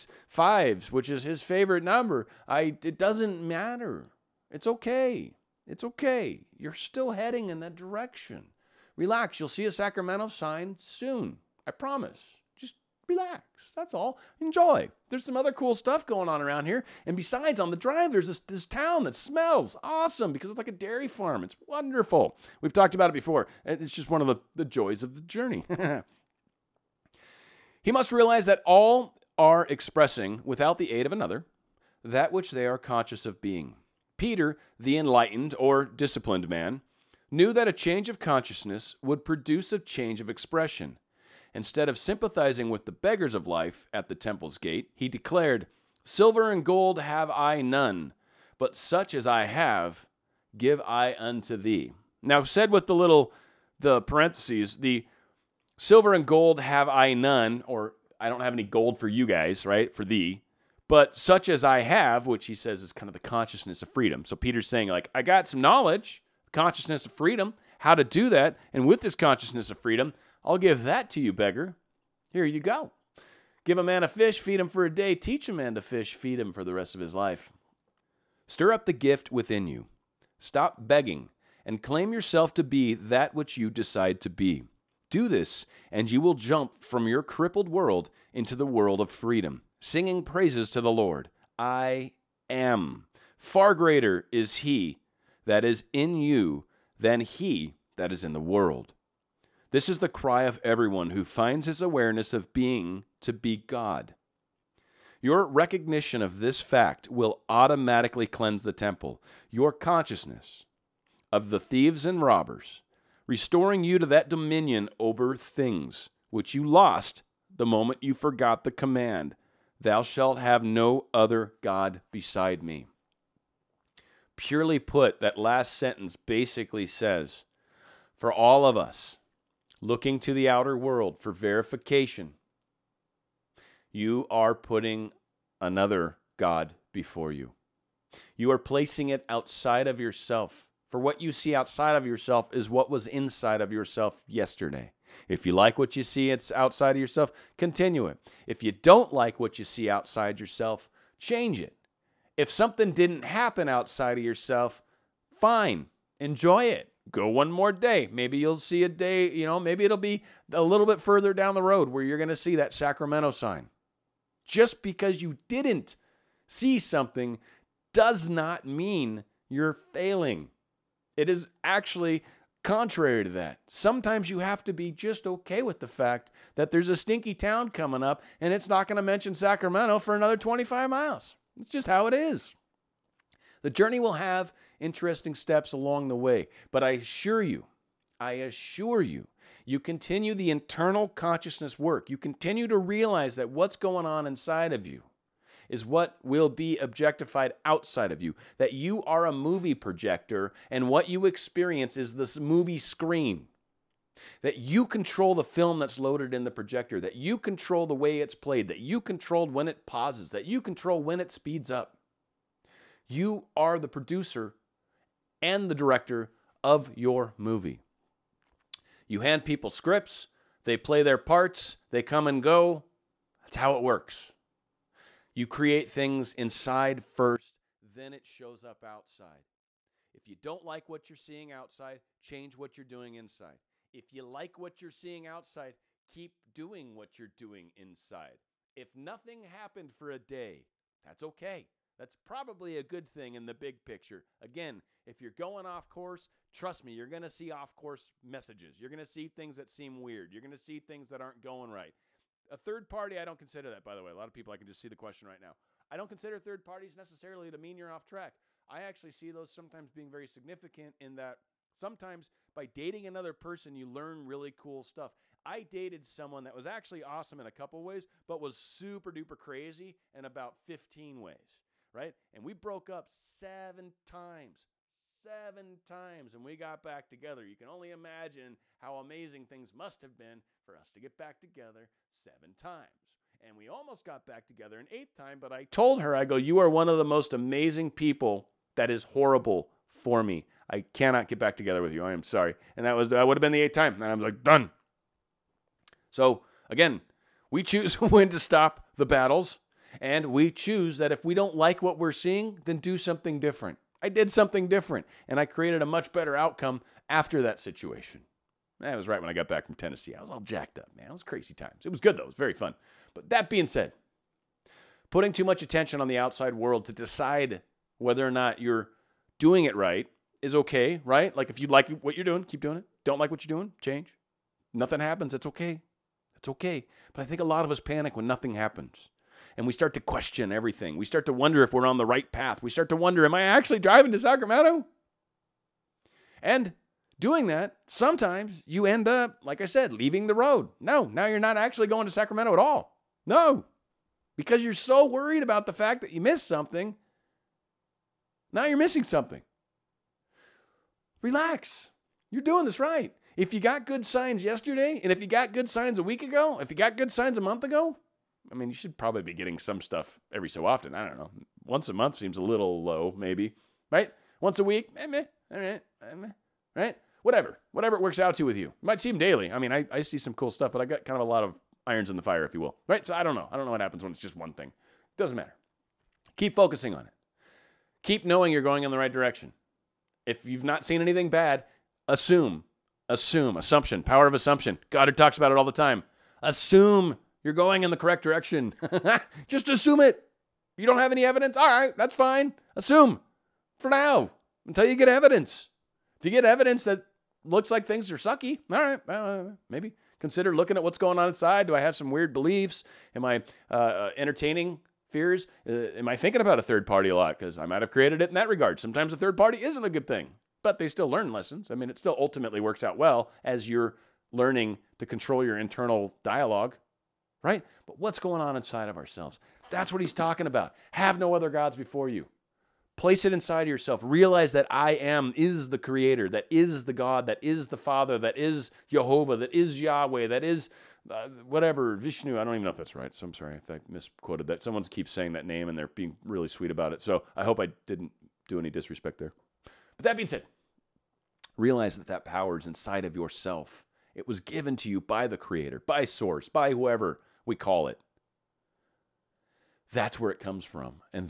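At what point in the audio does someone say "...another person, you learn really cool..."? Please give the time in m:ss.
4:23.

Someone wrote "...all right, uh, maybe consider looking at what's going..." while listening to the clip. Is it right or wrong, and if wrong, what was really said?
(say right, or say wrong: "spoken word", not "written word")
right.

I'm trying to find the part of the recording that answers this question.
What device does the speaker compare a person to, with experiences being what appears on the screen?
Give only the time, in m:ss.
3:19.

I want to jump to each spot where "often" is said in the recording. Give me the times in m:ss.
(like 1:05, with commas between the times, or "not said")
6:00.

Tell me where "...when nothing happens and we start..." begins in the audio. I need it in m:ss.
5:28.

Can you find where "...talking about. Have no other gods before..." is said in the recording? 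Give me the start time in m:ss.
7:00.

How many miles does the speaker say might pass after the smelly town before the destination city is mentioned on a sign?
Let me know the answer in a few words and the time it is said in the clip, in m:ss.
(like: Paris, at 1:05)
25, at 3:00.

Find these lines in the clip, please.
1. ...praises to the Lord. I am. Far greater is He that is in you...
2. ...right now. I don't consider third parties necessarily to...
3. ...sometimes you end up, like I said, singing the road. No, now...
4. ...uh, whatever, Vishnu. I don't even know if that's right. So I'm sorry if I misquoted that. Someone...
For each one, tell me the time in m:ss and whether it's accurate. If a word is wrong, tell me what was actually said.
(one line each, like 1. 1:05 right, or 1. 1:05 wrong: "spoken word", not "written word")
1. 1:30 right
2. 4:15 right
3. 5:37 wrong: "leaving", not "singing"
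4. 7:11 right.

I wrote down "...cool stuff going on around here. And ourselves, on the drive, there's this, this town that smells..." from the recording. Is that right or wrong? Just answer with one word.
wrong.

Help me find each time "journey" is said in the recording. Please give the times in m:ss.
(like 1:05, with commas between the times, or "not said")
0:25, 3:03.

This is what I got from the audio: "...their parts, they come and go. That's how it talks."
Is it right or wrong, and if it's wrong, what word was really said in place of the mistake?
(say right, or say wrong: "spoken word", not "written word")
wrong: "works", not "talks".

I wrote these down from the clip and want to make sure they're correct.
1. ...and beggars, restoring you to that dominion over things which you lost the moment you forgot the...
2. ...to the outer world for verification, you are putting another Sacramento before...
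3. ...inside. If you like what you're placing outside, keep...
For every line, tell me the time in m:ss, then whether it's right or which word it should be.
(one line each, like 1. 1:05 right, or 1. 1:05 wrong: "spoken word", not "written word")
1. 1:52 wrong: "robbers", not "beggars"
2. 2:10 wrong: "God", not "Sacramento"
3. 3:53 wrong: "seeing", not "placing".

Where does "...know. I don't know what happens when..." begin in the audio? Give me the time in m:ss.
6:13.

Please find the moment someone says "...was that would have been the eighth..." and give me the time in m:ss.
4:52.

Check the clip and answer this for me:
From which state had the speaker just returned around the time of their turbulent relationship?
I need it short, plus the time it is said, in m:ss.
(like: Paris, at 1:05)
Tennessee, at 5:09.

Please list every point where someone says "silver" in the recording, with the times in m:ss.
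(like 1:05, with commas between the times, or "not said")
0:46, 0:55.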